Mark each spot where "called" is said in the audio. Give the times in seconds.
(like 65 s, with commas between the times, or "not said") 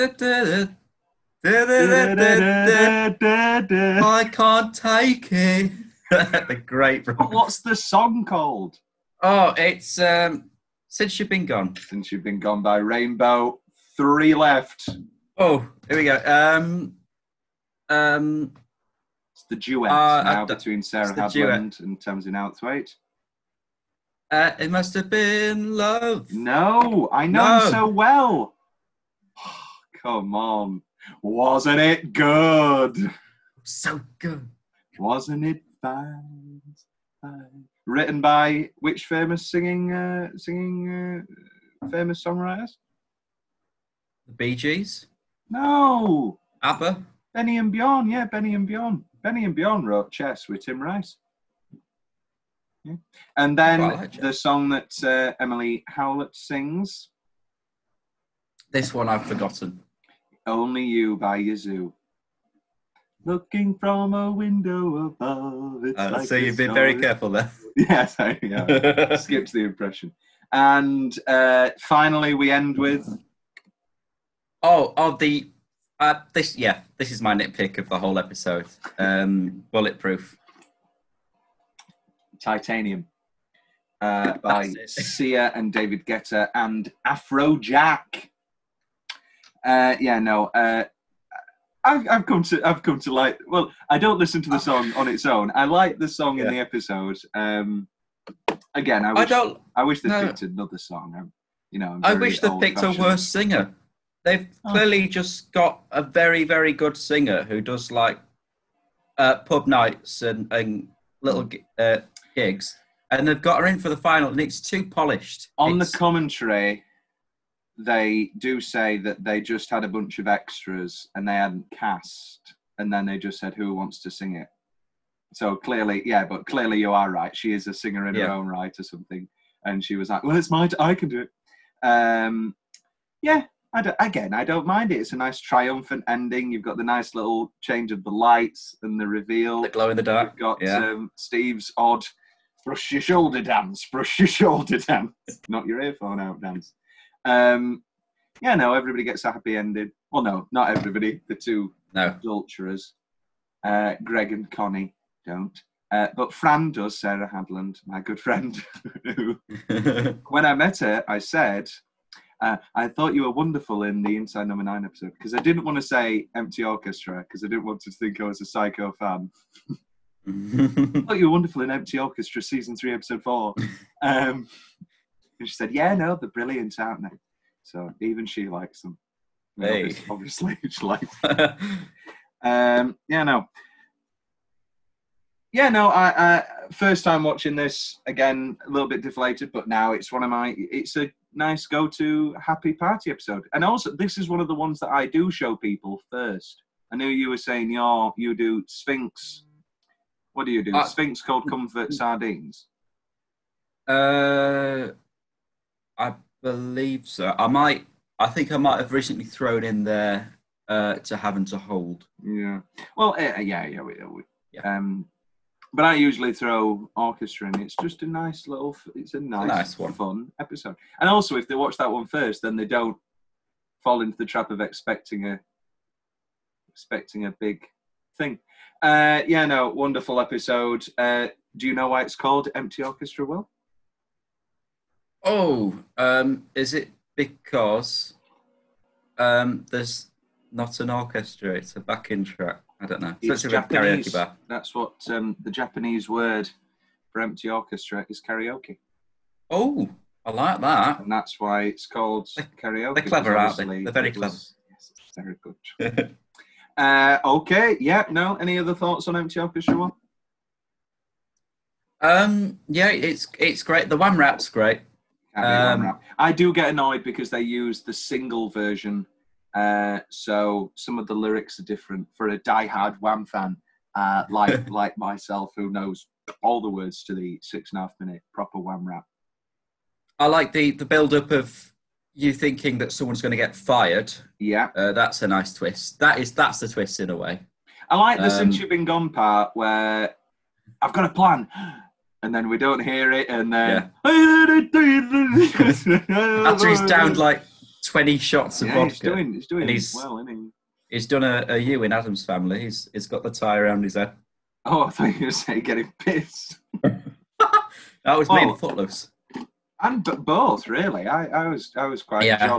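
8 s, 201 s, 232 s, 251 s.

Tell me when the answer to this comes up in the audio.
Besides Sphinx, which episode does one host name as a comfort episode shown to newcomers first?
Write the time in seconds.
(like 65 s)
201 s.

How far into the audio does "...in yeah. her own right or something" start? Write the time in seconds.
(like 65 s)
128 s.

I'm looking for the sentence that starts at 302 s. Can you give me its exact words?
He's, he's got the tie around his head.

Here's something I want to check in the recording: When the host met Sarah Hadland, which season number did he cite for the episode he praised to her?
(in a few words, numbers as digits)
3.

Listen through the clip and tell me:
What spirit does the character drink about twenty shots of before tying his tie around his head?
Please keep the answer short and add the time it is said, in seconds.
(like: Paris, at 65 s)
Vodka, at 298 s.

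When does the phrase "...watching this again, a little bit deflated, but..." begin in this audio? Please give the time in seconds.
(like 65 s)
187 s.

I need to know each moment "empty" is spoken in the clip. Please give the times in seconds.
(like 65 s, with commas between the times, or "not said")
166 s, 171 s, 232 s, 247 s, 259 s.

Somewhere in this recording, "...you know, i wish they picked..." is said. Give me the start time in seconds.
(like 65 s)
101 s.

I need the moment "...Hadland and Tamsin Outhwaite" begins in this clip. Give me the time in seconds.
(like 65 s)
21 s.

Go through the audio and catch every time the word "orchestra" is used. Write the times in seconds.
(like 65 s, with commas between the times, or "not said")
166 s, 171 s, 216 s, 232 s, 240 s, 247 s, 259 s.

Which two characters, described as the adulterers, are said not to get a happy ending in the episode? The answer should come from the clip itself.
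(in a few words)
Greg and Connie.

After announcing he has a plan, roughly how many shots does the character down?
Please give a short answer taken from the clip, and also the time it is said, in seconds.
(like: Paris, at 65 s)
20, at 297 s.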